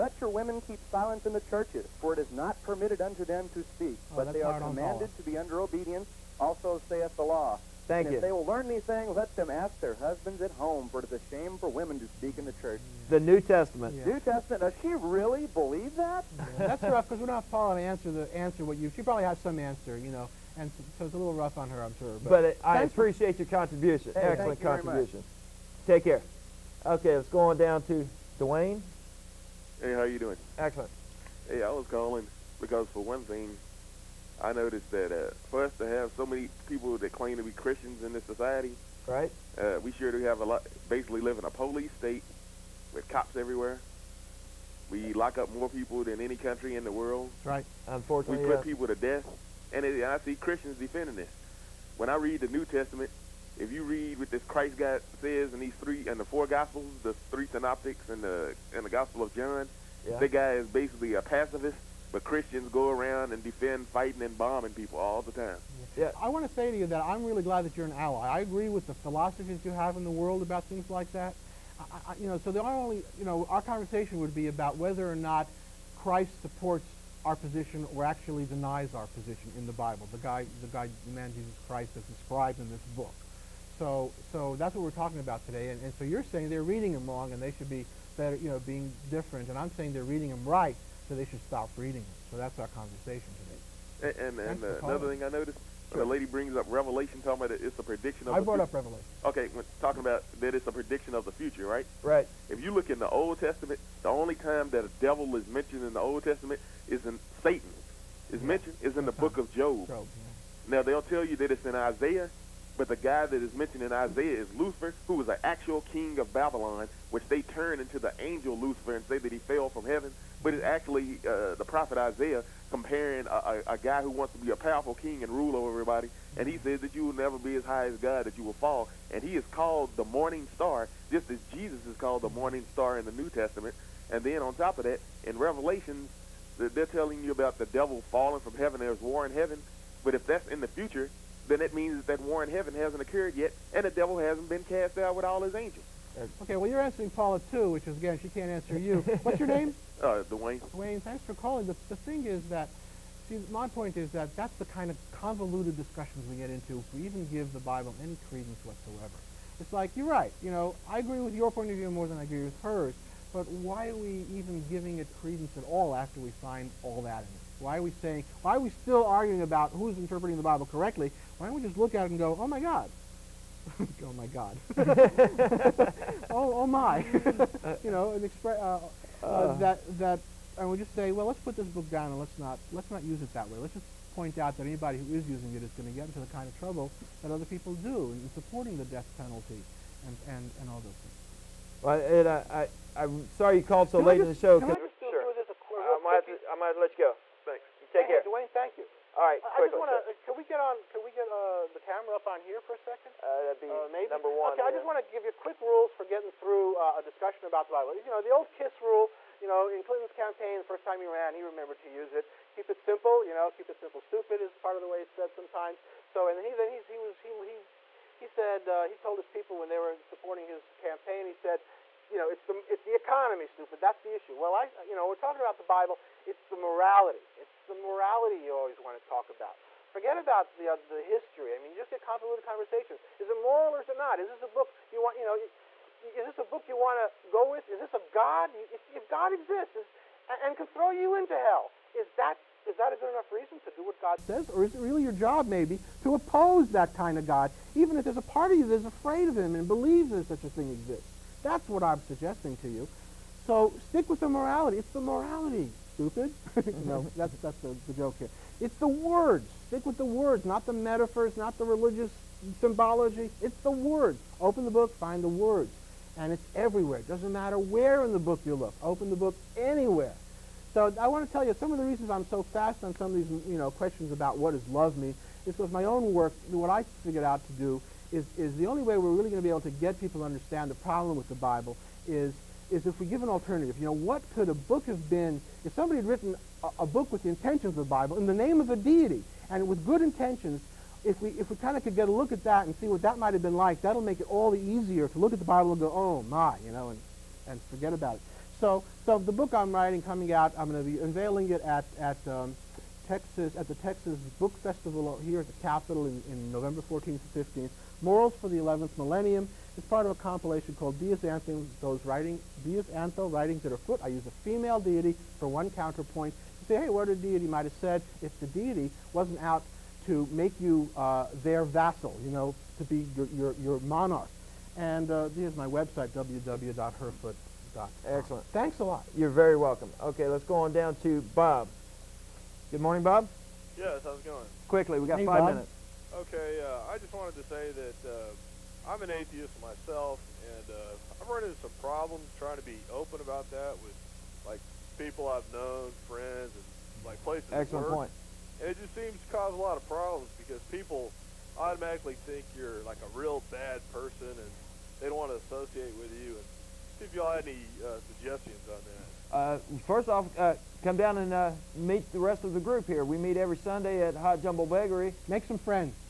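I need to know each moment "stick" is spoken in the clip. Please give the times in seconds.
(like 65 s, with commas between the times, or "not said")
253 s, 259 s.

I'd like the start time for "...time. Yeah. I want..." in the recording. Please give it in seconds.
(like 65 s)
65 s.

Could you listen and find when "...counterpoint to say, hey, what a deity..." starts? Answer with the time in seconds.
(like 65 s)
315 s.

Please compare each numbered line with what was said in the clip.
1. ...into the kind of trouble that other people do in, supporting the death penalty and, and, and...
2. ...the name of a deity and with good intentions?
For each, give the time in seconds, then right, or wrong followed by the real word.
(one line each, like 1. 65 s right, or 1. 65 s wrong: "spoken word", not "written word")
1. 186 s right
2. 288 s right.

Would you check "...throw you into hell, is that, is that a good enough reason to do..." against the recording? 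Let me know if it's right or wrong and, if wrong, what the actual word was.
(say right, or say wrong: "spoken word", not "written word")
right.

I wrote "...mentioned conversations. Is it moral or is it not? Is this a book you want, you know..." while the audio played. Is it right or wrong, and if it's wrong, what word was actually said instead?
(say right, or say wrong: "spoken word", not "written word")
wrong: "convoluted", not "mentioned".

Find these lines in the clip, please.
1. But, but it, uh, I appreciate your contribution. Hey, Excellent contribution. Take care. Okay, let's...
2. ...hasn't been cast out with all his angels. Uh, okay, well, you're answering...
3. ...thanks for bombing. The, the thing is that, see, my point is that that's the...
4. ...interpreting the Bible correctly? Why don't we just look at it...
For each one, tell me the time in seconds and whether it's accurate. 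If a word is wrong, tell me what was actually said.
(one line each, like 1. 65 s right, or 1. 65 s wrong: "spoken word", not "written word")
1. 22 s right
2. 144 s right
3. 151 s wrong: "calling", not "bombing"
4. 169 s right.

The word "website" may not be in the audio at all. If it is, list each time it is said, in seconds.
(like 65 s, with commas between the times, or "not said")
325 s.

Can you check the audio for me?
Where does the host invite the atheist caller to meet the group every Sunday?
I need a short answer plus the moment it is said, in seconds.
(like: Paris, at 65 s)
Hot Jumble Bakery, at 364 s.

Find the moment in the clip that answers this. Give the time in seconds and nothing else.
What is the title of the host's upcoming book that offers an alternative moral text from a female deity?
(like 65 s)
308 s.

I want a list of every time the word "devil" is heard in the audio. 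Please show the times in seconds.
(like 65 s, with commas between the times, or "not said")
104 s, 137 s, 143 s.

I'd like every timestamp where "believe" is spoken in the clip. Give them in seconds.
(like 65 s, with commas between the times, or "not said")
15 s, 249 s.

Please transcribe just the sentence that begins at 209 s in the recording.
You know, in Clinton's campaign, the first time he ran, he remembered to use it.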